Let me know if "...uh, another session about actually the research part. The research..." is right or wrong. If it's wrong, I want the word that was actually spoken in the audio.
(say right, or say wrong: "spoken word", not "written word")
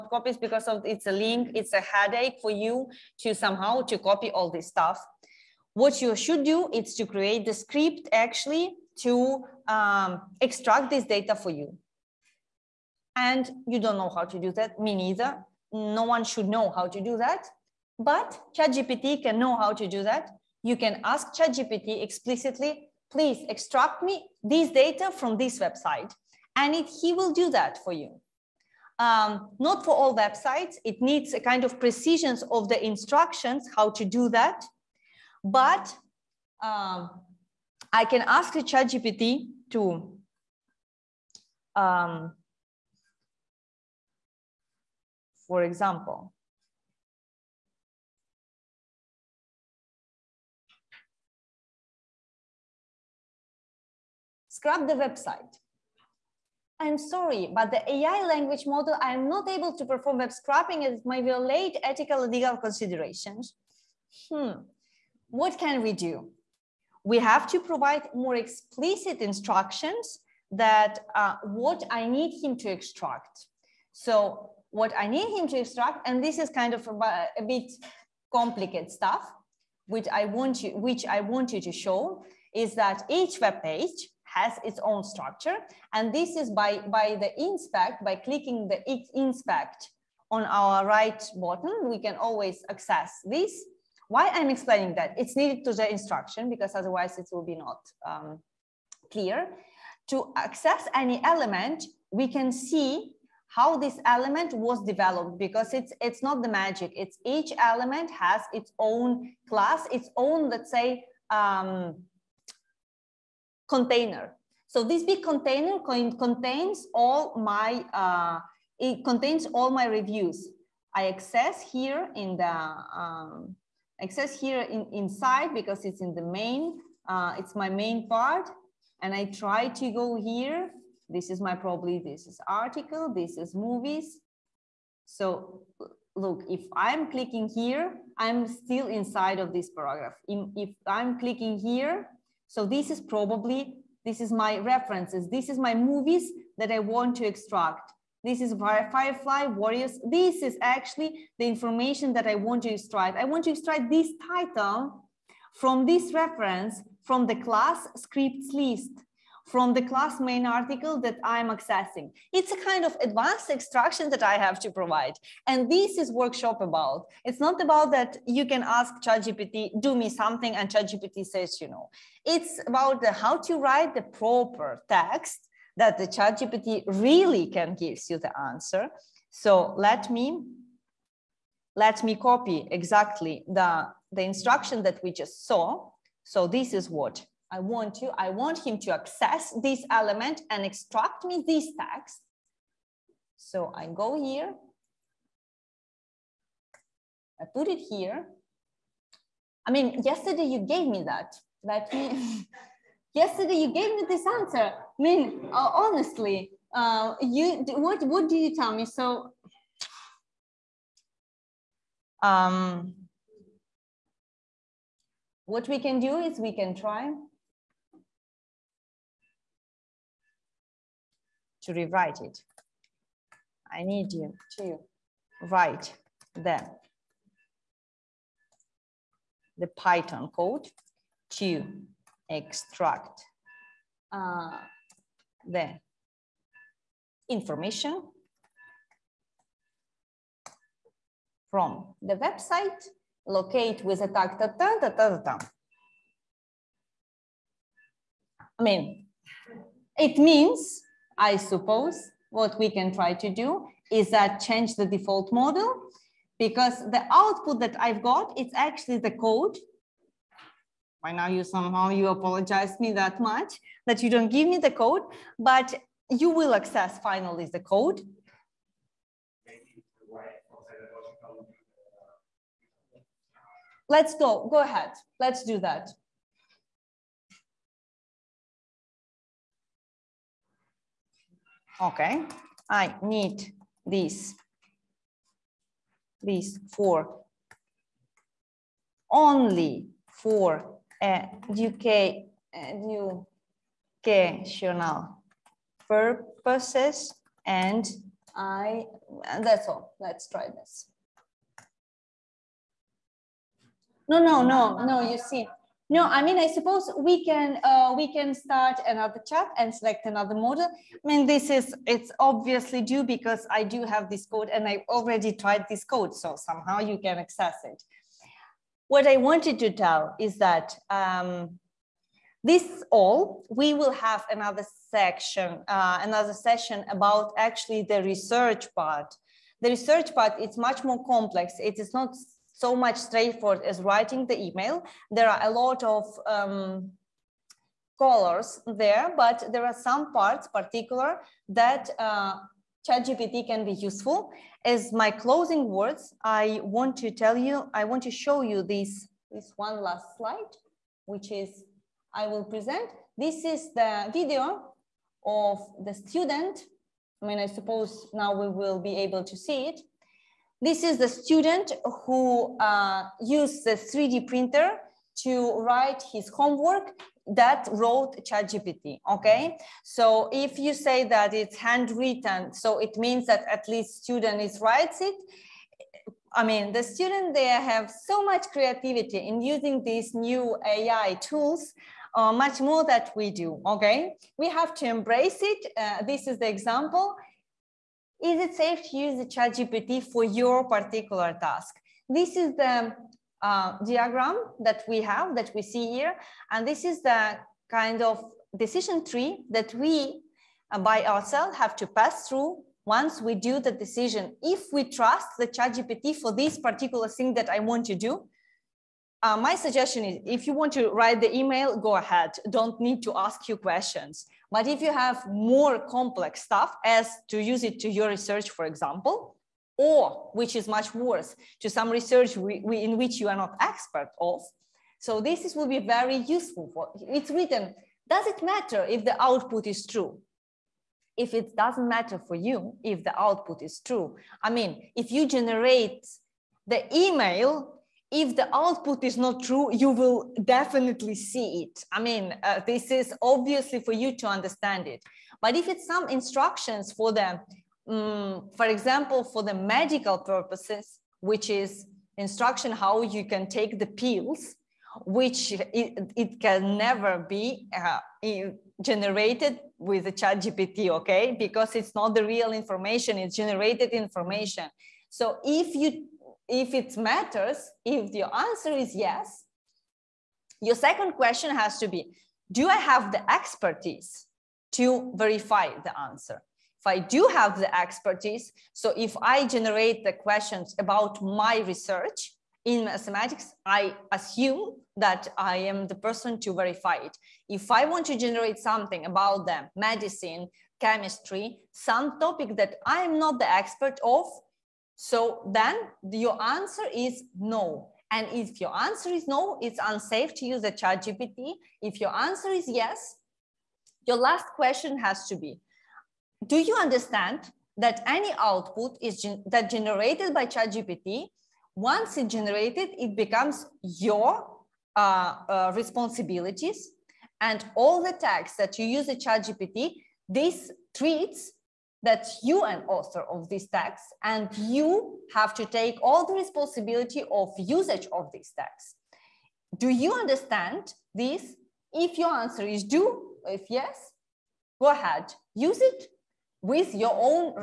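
right.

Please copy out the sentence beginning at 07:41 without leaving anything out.
Because it's not the real information, it's generated information.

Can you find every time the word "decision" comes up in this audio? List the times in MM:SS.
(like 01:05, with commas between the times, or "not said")
06:38, 06:43.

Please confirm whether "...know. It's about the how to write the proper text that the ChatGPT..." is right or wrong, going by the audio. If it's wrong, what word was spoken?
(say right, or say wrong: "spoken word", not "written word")
right.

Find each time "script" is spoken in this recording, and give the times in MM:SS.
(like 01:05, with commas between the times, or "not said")
00:07, 02:37.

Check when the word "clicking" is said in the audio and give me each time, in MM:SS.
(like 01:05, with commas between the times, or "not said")
01:28, 02:17, 02:21.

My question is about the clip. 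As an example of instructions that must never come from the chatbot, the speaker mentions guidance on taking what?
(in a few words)
Pills.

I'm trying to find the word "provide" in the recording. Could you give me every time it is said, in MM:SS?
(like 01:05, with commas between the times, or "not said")
01:07, 02:44.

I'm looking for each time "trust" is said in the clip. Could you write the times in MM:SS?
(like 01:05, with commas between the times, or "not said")
06:44.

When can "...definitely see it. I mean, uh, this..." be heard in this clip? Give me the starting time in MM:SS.
07:20.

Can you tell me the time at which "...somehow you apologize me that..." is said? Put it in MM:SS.
04:21.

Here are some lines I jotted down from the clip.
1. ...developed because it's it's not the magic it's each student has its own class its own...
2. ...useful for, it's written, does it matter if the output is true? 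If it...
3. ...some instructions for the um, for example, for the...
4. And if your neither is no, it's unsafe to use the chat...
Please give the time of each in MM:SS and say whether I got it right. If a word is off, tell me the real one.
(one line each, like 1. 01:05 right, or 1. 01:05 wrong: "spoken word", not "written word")
1. 01:44 wrong: "element", not "student"
2. 07:06 right
3. 07:25 right
4. 08:18 wrong: "answer", not "neither".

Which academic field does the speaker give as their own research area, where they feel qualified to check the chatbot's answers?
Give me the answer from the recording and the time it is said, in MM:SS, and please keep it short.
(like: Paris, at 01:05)
Mathematics, at 08:02.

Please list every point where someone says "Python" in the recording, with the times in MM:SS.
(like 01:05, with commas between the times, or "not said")
03:49.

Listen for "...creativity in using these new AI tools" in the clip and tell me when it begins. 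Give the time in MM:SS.
06:18.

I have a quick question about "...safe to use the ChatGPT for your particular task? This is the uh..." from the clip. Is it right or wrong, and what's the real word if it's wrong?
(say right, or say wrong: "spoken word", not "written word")
right.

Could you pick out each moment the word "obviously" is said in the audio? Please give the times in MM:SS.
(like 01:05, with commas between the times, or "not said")
05:12, 07:23.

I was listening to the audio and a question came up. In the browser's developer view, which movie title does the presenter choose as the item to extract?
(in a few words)
Firefly Warriors.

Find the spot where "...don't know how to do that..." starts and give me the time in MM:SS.
00:13.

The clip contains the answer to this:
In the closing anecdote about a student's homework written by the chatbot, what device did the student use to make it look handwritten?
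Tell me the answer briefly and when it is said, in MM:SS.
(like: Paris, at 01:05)
3D printer, at 06:03.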